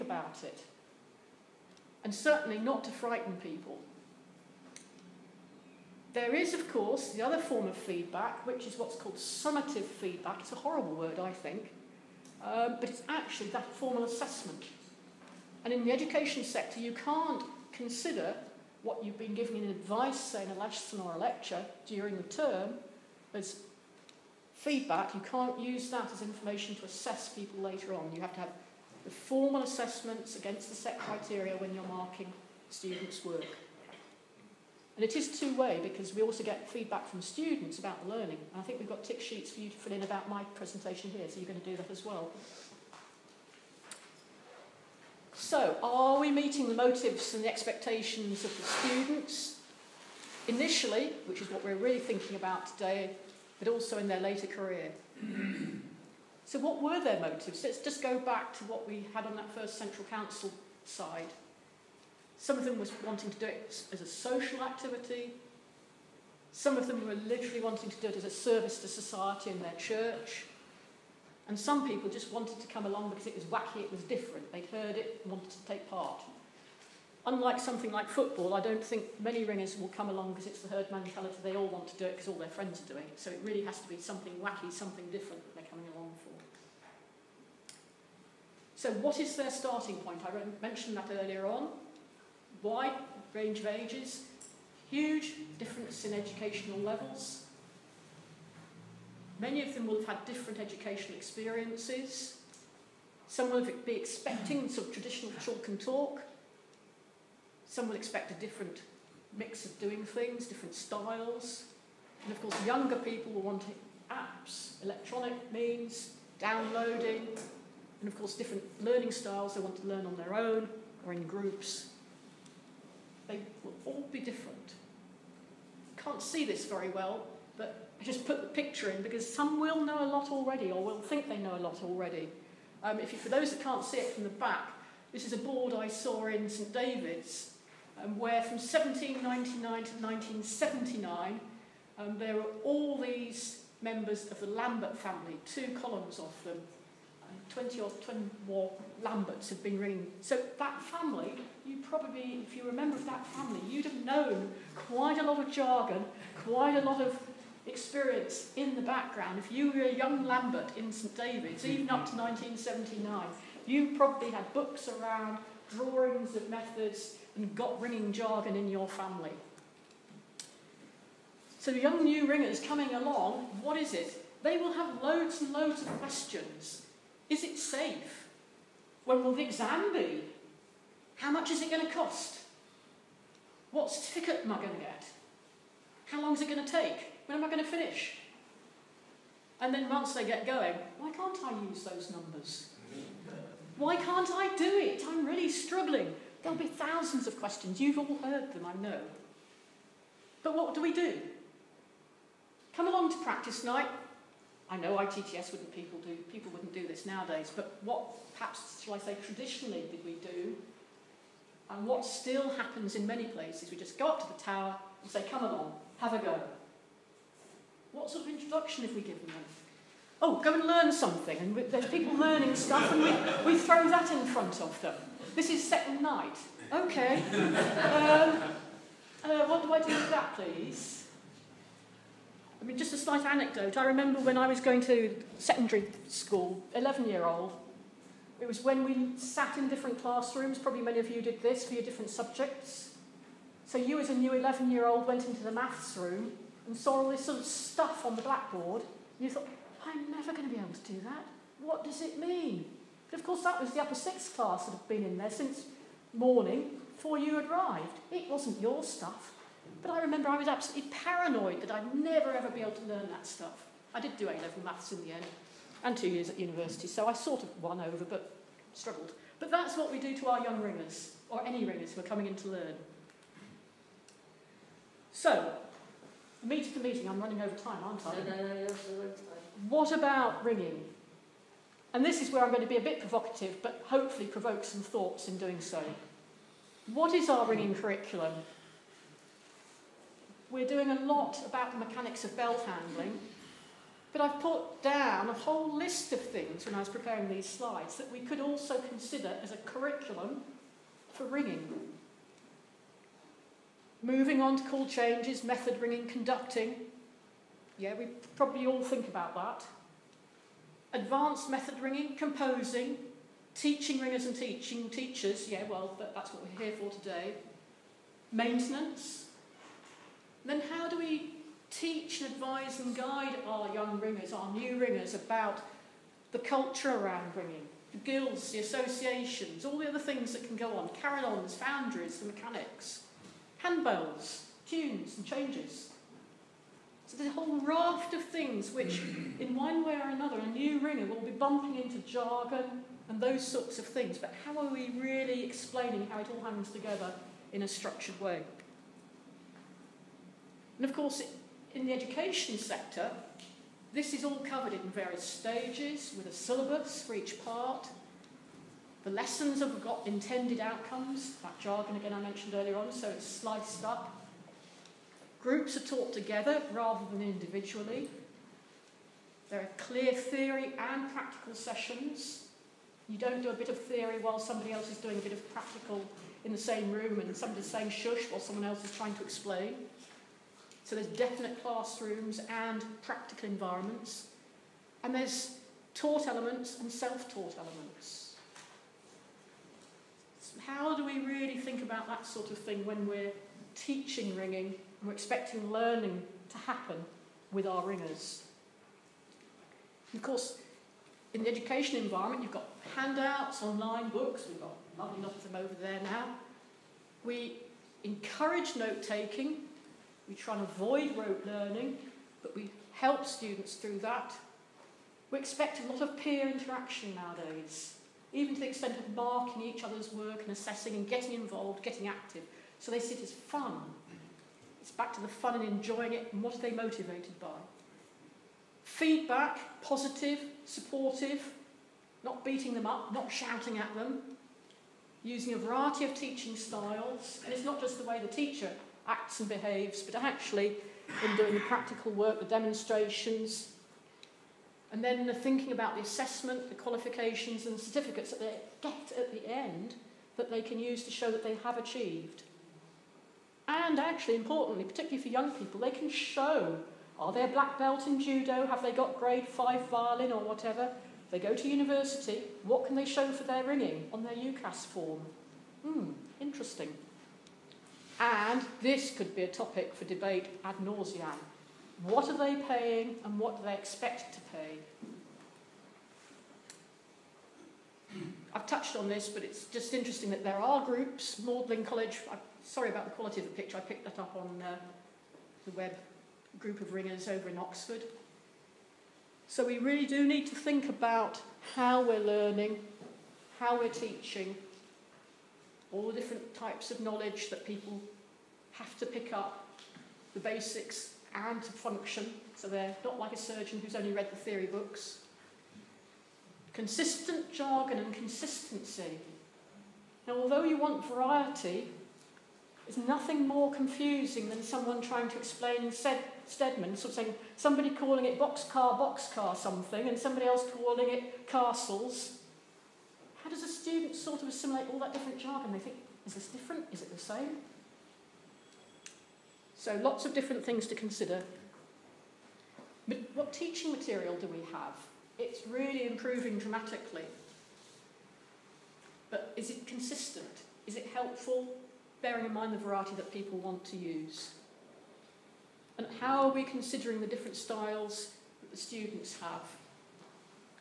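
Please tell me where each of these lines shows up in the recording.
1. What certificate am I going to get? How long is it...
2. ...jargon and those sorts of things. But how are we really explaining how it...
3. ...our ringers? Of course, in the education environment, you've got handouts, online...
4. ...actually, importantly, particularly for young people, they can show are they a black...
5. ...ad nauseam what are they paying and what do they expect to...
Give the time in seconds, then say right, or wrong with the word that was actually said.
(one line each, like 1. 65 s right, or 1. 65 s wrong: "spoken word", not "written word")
1. 183 s right
2. 341 s right
3. 397 s right
4. 453 s right
5. 470 s right.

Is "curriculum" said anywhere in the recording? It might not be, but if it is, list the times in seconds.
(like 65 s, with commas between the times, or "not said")
287 s, 299 s.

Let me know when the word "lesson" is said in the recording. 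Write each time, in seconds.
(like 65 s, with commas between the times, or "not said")
20 s, 359 s.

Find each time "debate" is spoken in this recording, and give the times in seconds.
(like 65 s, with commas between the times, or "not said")
470 s.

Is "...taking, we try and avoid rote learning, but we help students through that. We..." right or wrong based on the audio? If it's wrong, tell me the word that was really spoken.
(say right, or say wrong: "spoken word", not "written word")
right.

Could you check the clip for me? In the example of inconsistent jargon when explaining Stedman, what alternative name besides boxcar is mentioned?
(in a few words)
Castles.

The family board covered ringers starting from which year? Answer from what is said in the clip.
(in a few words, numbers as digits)
1799.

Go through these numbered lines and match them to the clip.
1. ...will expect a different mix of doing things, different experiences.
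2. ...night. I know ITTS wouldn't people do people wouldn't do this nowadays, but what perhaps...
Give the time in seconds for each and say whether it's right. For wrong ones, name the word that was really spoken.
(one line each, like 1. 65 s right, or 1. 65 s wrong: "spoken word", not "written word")
1. 107 s wrong: "styles", not "experiences"
2. 203 s right.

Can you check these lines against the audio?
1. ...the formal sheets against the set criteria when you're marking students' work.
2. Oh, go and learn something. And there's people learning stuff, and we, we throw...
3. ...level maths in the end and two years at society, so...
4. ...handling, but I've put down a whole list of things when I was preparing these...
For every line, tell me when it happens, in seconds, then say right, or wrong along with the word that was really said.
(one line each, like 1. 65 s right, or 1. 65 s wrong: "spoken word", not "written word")
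1. 29 s wrong: "assessments", not "sheets"
2. 220 s right
3. 264 s wrong: "university", not "society"
4. 292 s right.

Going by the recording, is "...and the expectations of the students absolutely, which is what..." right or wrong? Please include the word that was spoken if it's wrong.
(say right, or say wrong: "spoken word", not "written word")
wrong: "initially", not "absolutely".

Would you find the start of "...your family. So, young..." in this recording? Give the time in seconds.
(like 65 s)
168 s.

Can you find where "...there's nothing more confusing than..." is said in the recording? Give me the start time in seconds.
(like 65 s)
512 s.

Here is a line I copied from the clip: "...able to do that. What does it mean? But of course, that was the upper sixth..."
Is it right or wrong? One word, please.
right.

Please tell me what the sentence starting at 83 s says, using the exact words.
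So it really has to be something wacky, something different that they're coming along for.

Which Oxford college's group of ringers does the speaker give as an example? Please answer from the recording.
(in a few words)
Magdalen College.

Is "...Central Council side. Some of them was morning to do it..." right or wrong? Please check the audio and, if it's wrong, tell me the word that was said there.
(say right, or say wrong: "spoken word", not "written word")
wrong: "wanting", not "morning".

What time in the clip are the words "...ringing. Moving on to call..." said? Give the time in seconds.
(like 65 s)
301 s.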